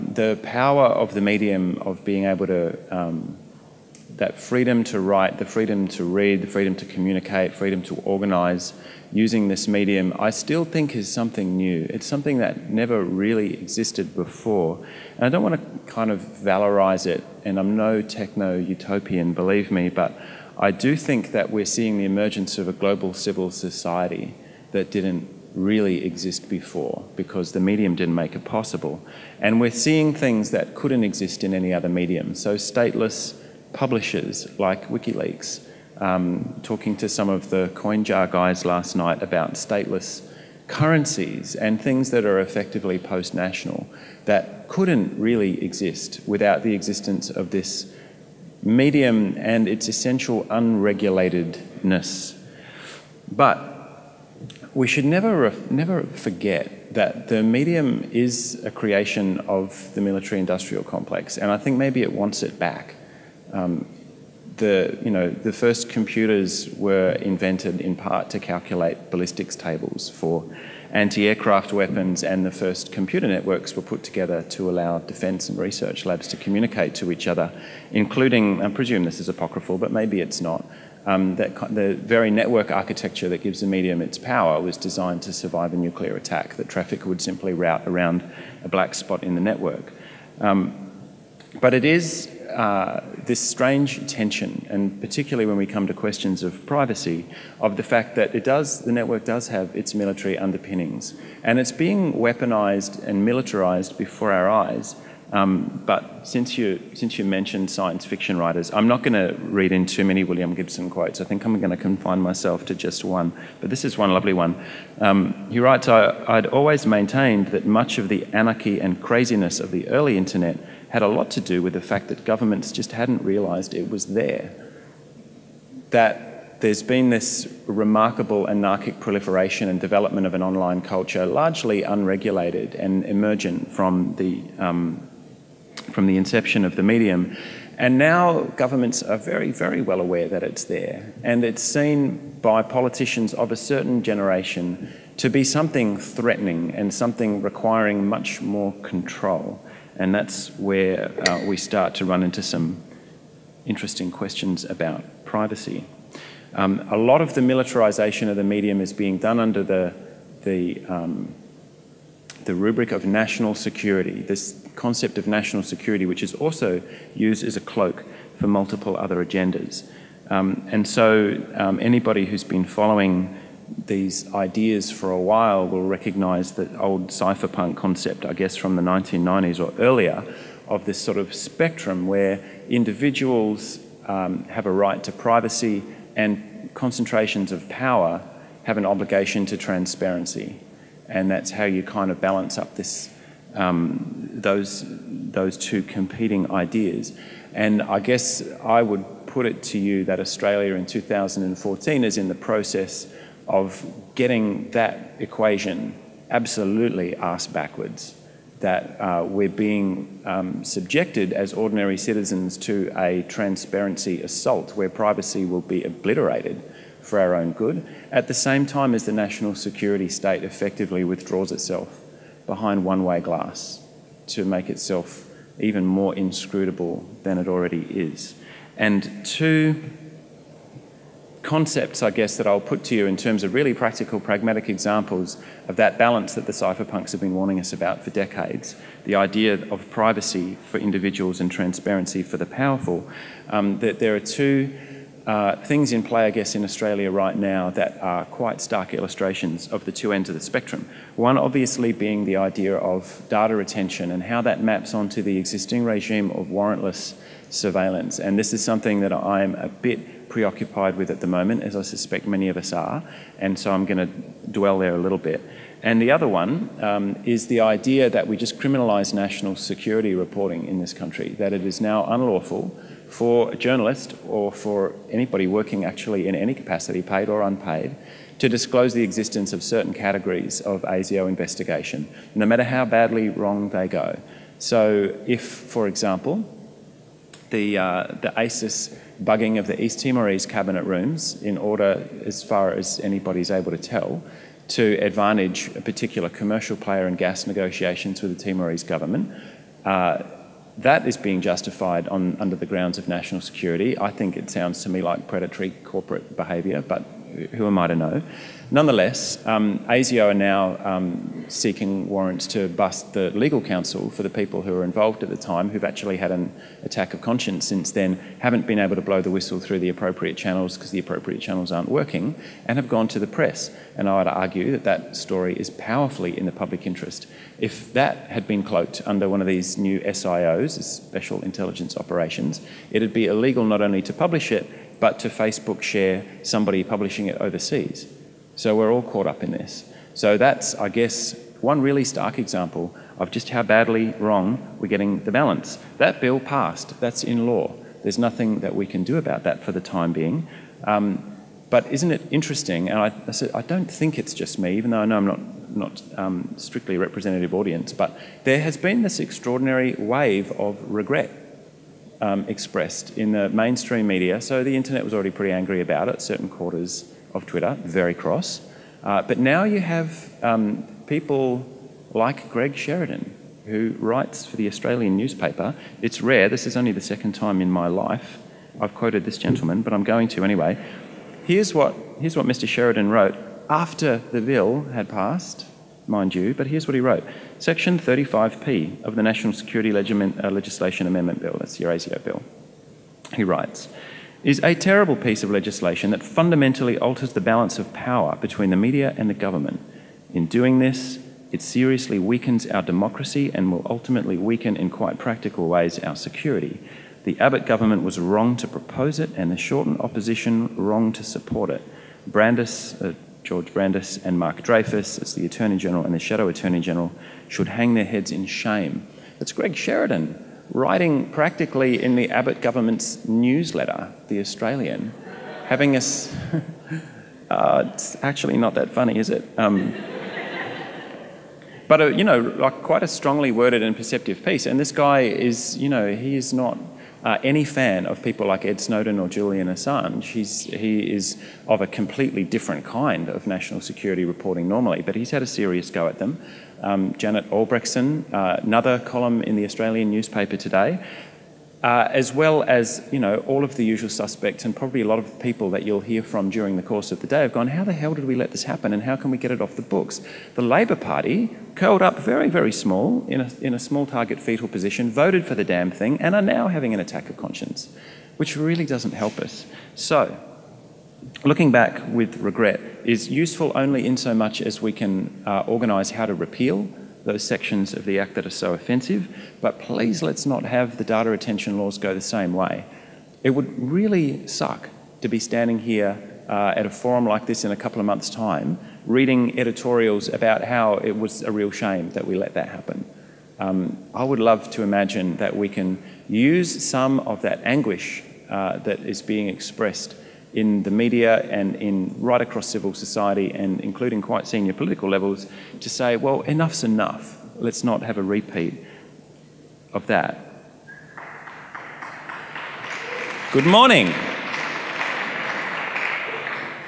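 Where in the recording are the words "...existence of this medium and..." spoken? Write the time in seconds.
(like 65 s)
46 s.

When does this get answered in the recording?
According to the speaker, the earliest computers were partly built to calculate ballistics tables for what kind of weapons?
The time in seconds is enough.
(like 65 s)
70 s.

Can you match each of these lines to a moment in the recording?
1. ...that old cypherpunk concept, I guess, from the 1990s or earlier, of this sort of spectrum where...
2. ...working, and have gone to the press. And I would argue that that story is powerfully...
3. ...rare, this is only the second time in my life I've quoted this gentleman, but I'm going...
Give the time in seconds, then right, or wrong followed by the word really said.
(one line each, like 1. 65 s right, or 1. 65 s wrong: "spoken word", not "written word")
1. 176 s right
2. 321 s right
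3. 376 s right.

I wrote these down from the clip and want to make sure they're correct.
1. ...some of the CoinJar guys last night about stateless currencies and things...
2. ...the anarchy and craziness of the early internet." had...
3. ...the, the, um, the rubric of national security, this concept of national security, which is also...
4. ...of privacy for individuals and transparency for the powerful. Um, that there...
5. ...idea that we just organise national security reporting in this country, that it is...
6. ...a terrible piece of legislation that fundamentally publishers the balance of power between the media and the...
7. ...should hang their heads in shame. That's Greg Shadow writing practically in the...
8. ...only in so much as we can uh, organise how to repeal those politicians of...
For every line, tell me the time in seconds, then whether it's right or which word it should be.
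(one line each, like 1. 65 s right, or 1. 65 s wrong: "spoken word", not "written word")
1. 37 s right
2. 118 s right
3. 159 s right
4. 239 s right
5. 267 s wrong: "criminalise", not "organise"
6. 394 s wrong: "alters", not "publishers"
7. 417 s wrong: "Sheridan", not "Shadow"
8. 473 s wrong: "sections", not "politicians".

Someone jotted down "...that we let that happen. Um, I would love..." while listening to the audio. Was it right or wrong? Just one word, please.
right.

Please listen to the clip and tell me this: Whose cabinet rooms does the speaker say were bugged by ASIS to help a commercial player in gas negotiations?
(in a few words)
East Timorese.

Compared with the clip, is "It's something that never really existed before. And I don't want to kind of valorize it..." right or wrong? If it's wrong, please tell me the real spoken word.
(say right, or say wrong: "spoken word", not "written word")
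right.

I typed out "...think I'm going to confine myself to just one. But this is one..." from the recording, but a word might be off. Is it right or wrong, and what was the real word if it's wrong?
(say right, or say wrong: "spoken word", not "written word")
right.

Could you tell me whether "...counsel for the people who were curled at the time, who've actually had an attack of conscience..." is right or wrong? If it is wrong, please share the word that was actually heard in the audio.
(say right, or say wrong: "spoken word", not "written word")
wrong: "involved", not "curled".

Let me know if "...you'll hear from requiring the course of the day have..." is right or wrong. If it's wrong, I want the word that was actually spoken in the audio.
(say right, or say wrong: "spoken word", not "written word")
wrong: "during", not "requiring".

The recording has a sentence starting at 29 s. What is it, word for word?
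And we're seeing things that couldn't exist in any other medium.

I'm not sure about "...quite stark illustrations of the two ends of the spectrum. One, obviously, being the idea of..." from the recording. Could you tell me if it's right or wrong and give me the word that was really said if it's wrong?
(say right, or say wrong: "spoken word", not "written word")
right.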